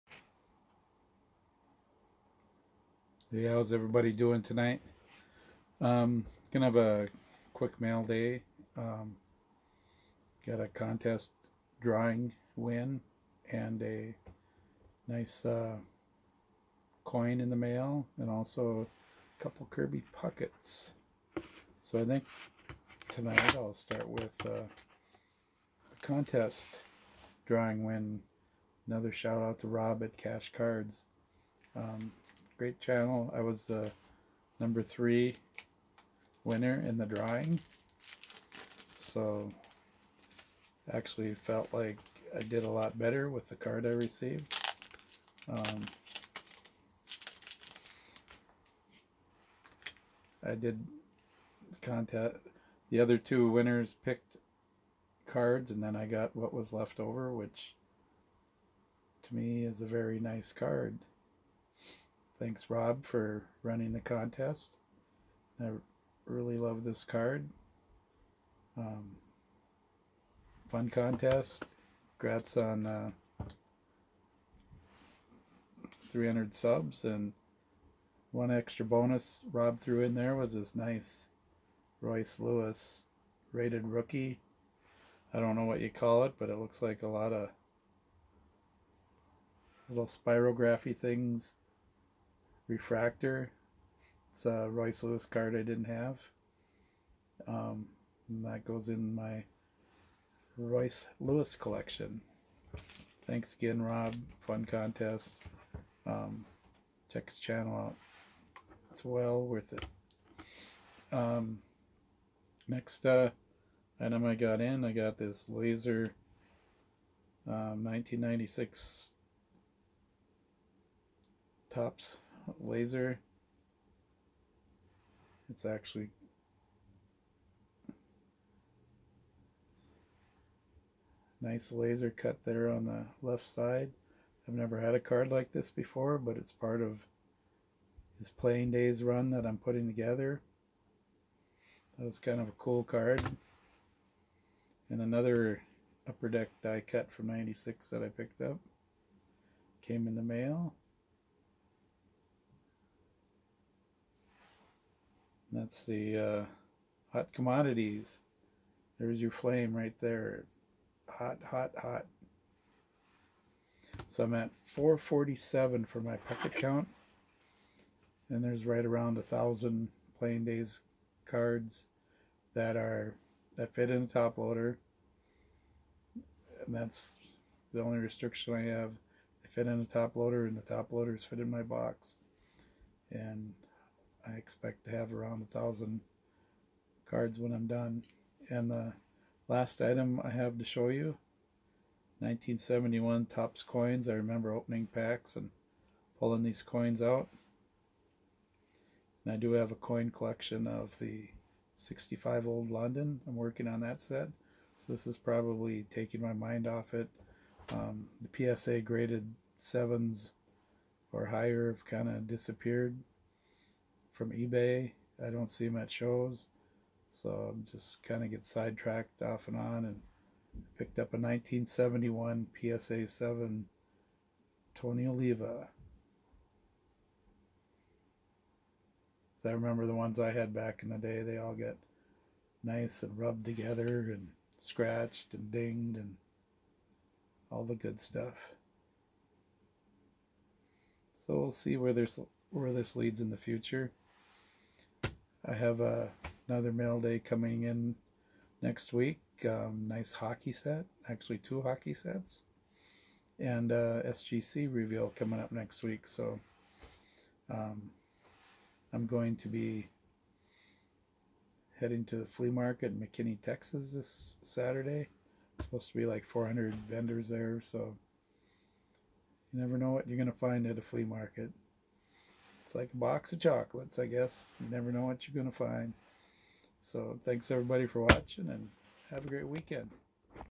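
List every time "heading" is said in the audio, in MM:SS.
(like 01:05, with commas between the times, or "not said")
04:21.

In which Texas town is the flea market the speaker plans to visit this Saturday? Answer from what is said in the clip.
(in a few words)
McKinney.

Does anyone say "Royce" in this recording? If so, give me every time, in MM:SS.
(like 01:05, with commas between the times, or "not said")
01:22, 01:34, 01:40.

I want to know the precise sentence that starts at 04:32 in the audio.
It's like a box of chocolates, I guess.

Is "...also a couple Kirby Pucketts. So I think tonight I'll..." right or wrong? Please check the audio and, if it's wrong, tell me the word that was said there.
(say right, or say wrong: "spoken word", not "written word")
right.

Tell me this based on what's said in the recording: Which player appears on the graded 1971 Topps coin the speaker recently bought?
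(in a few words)
Tony Oliva.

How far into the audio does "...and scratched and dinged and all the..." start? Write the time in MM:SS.
03:54.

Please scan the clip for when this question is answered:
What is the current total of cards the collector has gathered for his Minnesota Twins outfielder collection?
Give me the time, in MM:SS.
02:44.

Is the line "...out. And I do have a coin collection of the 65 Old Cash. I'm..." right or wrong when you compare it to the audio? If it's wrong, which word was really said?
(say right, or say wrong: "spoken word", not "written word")
wrong: "London", not "Cash".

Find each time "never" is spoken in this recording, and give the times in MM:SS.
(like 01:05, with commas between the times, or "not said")
02:14, 04:29, 04:34.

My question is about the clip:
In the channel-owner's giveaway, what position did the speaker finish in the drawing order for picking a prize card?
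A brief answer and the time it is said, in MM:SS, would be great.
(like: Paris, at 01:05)
number 3, at 00:34.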